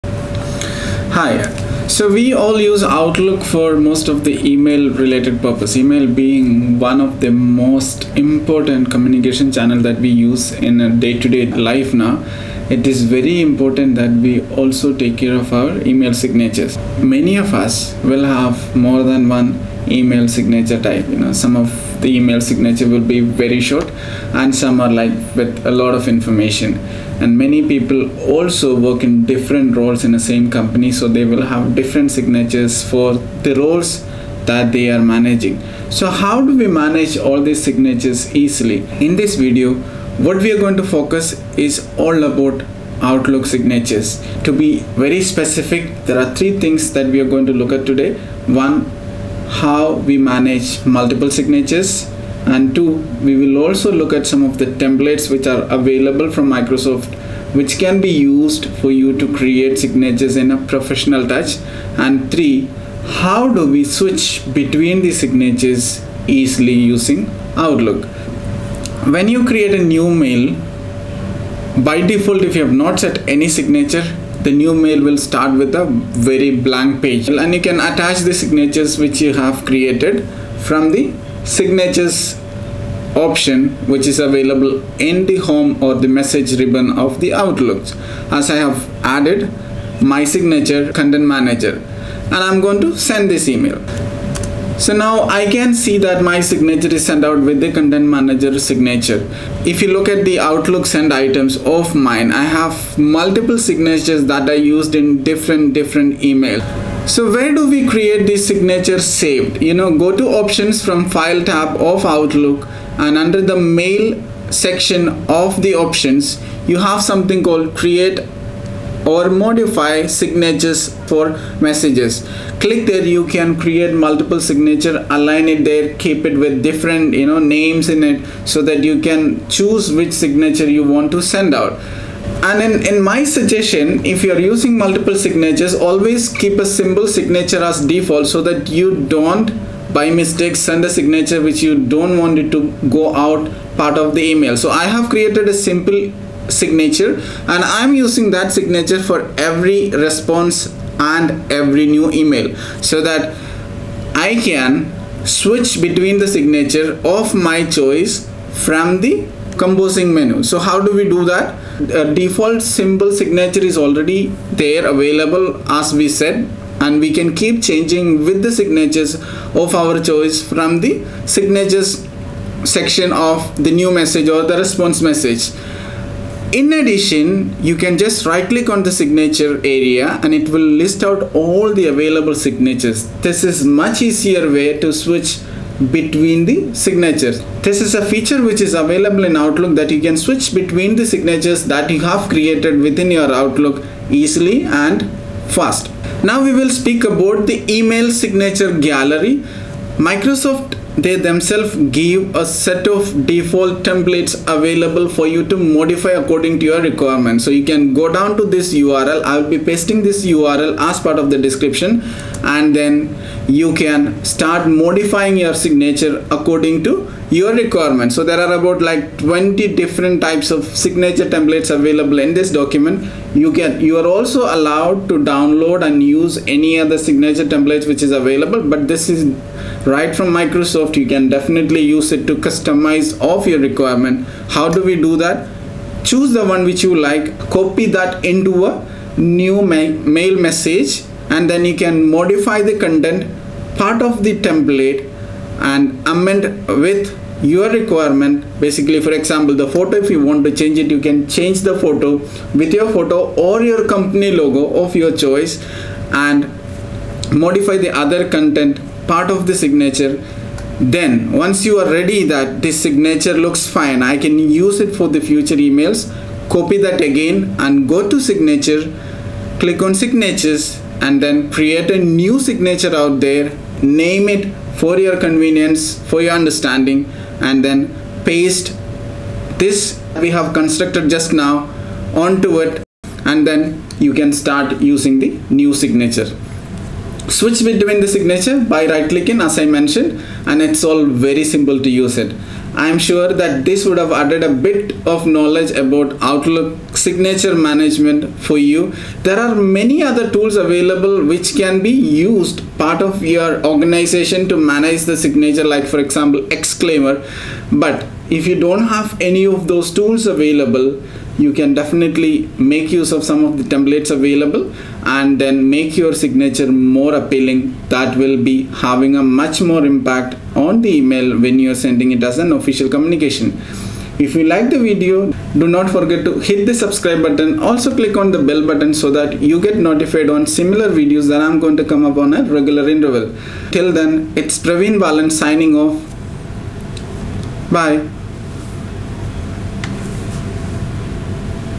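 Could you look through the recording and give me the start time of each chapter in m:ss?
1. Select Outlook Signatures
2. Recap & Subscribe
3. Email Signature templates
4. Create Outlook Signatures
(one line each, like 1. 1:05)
1. 2:33
2. 5:00
3. 3:15
4. 1:45.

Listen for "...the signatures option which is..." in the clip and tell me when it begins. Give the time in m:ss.
1:20.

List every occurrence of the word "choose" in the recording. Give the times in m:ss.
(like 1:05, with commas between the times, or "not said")
2:09, 3:56.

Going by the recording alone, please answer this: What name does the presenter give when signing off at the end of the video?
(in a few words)
Praveen Balan.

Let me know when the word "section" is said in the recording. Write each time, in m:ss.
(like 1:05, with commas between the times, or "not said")
1:54, 2:52.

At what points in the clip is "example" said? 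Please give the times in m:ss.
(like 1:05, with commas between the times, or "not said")
4:09, 5:05.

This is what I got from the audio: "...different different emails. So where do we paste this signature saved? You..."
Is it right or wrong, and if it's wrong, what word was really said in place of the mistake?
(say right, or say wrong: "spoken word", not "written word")
wrong: "create", not "paste".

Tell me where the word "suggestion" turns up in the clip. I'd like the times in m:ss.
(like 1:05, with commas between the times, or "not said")
2:13.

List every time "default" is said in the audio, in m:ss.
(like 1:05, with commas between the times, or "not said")
1:12, 2:17, 2:42, 3:23.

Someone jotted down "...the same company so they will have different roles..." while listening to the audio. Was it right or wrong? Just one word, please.
wrong.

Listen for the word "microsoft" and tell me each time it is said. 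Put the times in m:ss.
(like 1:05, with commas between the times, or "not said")
0:56, 3:20, 3:50.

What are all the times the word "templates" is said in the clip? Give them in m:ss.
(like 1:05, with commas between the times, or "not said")
0:54, 3:23, 3:41, 3:47, 4:04, 5:13.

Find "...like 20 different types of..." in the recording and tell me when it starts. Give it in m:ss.
3:38.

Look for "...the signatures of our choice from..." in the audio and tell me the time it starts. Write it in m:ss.
2:48.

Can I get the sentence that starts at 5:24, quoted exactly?
If you like the video, do not forget to hit the subscribe button.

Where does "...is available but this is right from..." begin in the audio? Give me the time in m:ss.
3:48.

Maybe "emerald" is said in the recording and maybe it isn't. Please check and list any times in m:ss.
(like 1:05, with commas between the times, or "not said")
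not said.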